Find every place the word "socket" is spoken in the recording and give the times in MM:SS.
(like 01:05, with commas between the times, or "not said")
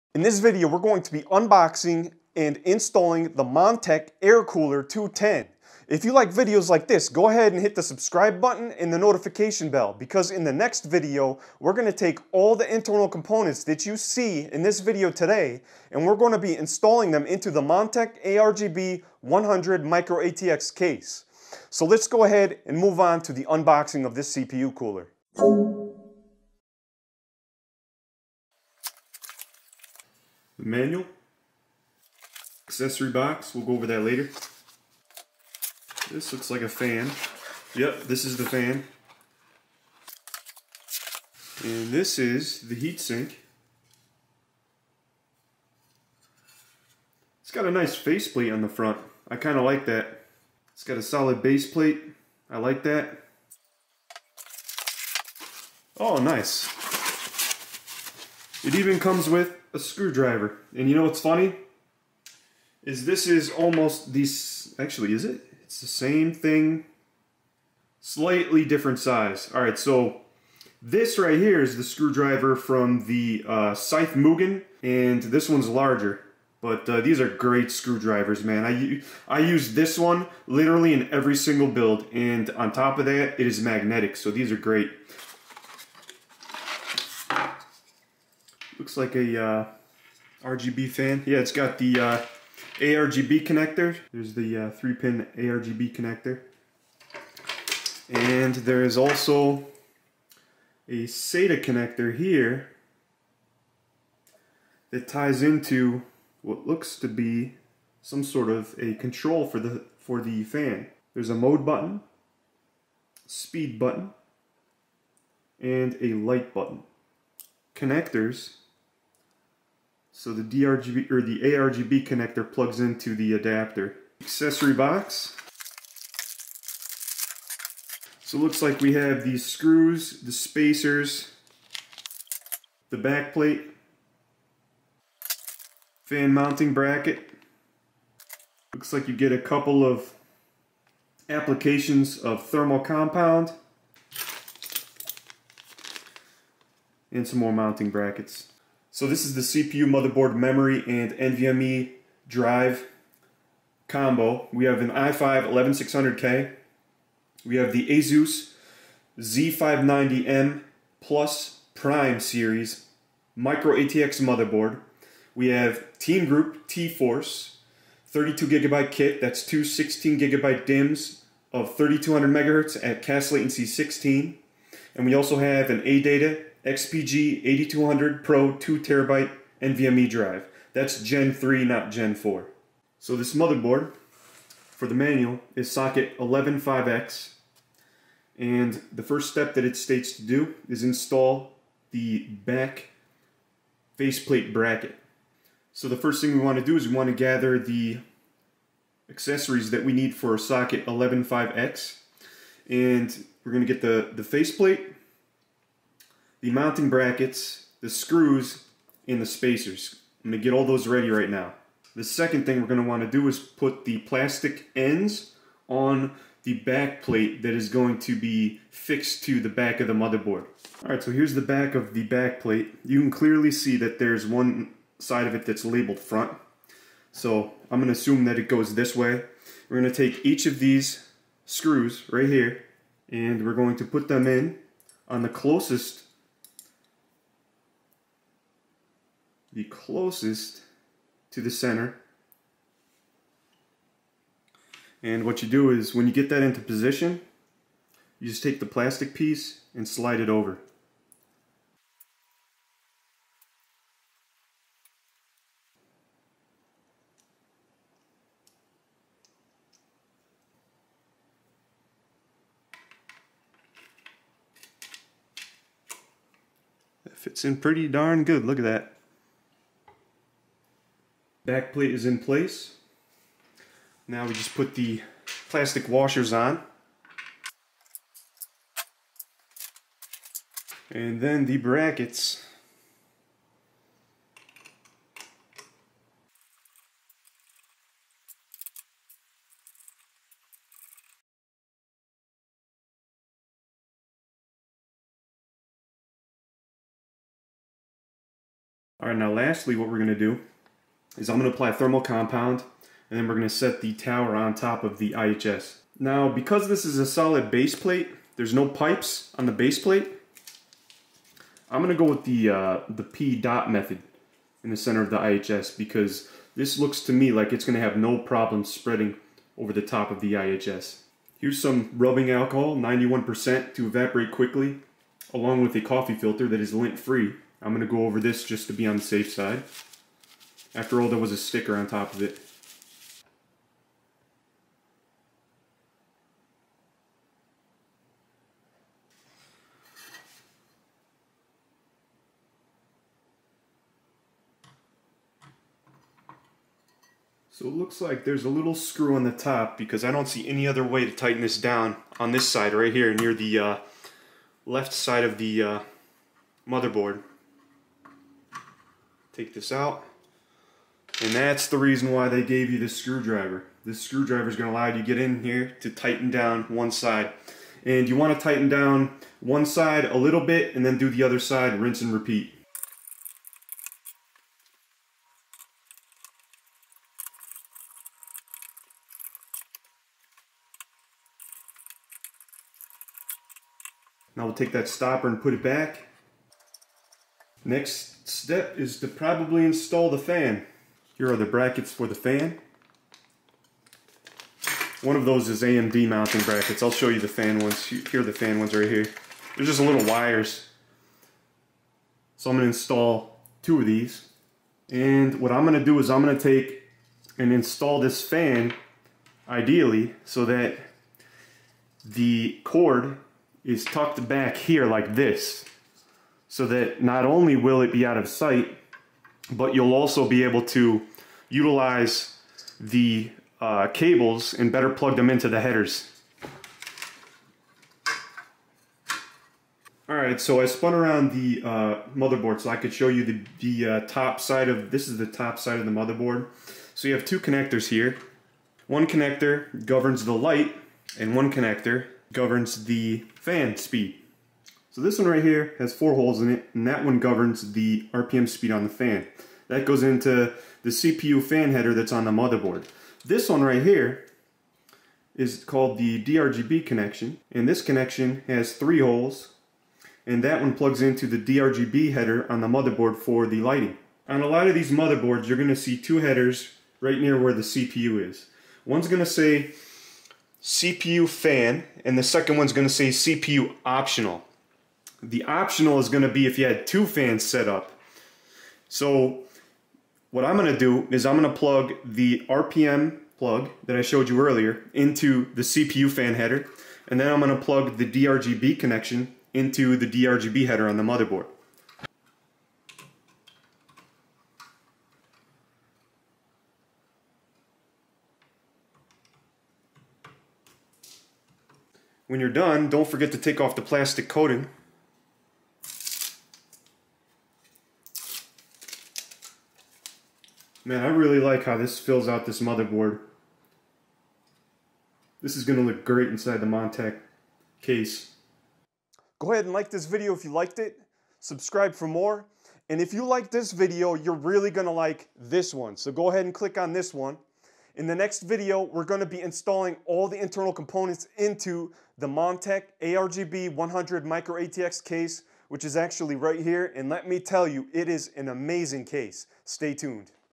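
03:05, 03:20.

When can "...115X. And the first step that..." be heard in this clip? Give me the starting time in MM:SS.
03:06.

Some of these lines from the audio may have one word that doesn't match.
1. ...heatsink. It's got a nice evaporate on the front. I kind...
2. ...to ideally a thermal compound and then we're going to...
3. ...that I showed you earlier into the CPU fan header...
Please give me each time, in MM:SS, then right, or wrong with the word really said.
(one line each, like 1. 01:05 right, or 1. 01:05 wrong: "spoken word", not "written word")
1. 00:42 wrong: "faceplate", not "evaporate"
2. 05:01 wrong: "apply", not "ideally"
3. 08:03 right.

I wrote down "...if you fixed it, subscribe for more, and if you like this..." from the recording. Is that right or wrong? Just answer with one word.
wrong.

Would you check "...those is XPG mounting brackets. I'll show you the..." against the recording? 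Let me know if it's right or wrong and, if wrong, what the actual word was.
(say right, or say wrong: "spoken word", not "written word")
wrong: "AMD", not "XPG".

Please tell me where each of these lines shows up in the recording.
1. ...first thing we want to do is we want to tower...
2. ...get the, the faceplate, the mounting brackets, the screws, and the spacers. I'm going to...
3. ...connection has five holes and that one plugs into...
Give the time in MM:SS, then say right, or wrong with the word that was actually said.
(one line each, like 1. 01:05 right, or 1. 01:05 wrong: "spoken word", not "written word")
1. 03:15 wrong: "gather", not "tower"
2. 03:23 right
3. 07:37 wrong: "three", not "five".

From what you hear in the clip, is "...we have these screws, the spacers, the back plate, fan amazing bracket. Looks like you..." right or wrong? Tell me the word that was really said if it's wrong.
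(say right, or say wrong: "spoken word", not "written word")
wrong: "mounting", not "amazing".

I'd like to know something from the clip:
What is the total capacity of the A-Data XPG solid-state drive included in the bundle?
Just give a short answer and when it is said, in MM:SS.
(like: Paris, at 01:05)
2TB, at 02:58.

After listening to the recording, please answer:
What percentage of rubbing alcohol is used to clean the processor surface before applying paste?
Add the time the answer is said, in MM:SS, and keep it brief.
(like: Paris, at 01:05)
91%, at 05:22.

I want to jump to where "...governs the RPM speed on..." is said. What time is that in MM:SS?
07:27.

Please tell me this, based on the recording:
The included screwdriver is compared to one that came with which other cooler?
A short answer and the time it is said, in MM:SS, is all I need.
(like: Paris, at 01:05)
Scythe Mugen, at 01:13.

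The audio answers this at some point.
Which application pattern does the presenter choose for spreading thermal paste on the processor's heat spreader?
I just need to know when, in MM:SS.
05:13.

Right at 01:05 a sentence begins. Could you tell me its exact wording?
It's the same thing, slightly different size.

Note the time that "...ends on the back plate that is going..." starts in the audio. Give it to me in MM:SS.
03:34.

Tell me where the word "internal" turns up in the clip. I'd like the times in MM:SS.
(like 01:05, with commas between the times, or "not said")
00:12, 08:50.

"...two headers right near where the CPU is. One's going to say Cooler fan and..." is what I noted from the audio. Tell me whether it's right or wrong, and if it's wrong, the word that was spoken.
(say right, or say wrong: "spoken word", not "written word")
wrong: "CPU", not "Cooler".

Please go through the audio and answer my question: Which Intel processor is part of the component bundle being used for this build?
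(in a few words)
i5 11600K.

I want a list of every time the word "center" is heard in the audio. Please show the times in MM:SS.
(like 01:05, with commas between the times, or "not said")
04:01, 05:14.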